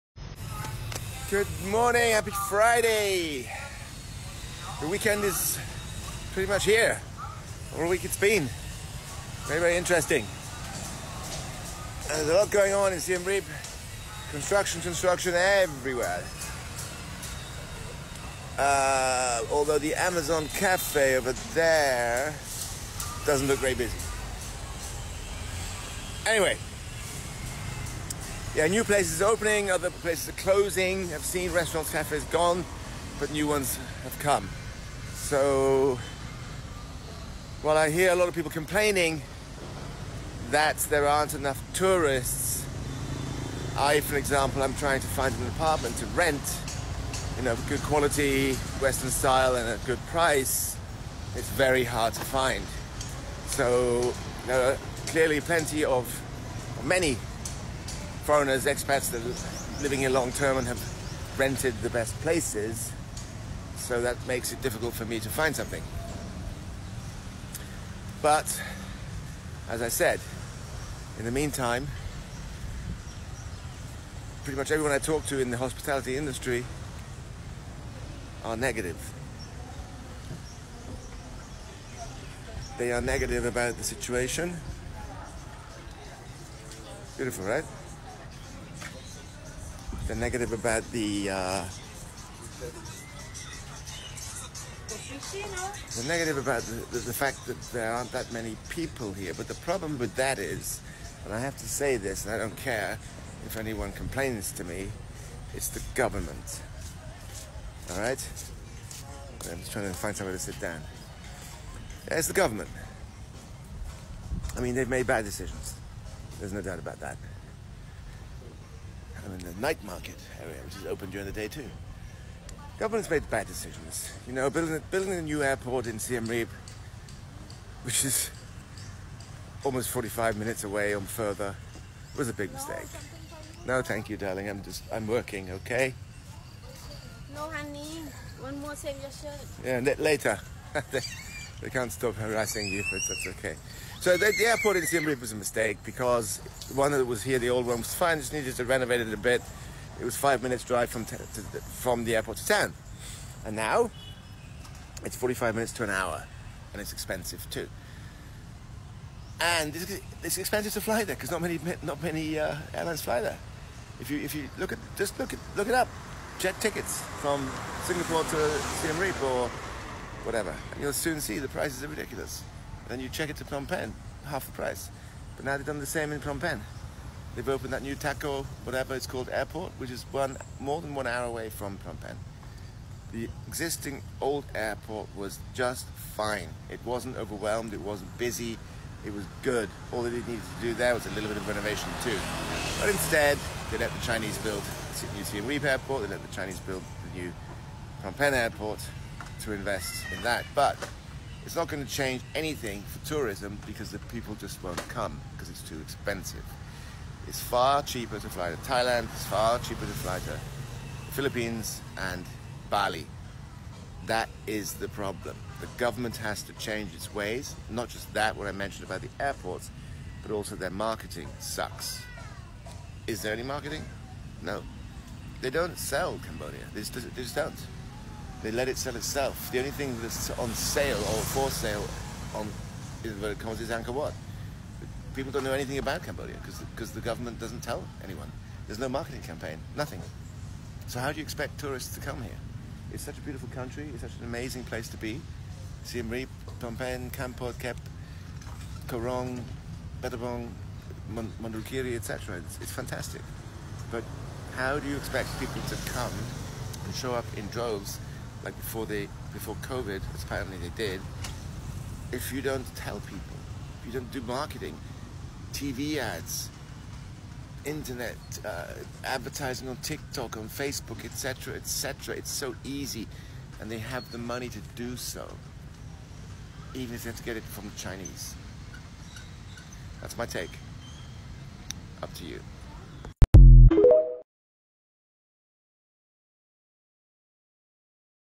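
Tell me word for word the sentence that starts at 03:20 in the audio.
But it's not going to change anything for tourism because the people just won't come because it's too expensive.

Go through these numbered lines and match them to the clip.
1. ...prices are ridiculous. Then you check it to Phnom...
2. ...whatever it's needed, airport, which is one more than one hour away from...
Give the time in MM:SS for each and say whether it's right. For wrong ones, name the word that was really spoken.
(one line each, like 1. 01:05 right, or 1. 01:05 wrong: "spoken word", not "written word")
1. 02:51 right
2. 02:58 wrong: "called", not "needed".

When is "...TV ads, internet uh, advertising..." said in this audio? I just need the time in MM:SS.
04:25.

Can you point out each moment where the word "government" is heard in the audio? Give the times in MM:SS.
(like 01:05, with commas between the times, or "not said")
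01:45, 01:52, 02:02, 03:35, 03:57.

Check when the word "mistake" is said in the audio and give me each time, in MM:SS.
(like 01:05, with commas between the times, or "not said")
02:12, 02:25.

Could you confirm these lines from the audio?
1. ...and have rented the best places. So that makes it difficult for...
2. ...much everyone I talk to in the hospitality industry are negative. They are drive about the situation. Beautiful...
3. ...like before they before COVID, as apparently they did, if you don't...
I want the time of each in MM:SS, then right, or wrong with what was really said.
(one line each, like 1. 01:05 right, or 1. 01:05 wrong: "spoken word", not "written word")
1. 01:00 right
2. 01:14 wrong: "negative", not "drive"
3. 04:18 right.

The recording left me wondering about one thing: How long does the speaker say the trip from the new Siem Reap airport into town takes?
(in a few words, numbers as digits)
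45 minutes to an hour.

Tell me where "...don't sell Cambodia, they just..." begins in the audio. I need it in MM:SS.
03:45.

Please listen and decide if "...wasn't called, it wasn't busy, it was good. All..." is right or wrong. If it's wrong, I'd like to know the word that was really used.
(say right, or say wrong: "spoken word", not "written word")
wrong: "overwhelmed", not "called".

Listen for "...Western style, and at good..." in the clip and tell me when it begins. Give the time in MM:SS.
00:48.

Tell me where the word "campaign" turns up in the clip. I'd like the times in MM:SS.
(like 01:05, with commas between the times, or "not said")
03:59.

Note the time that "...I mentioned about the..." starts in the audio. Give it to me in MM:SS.
03:38.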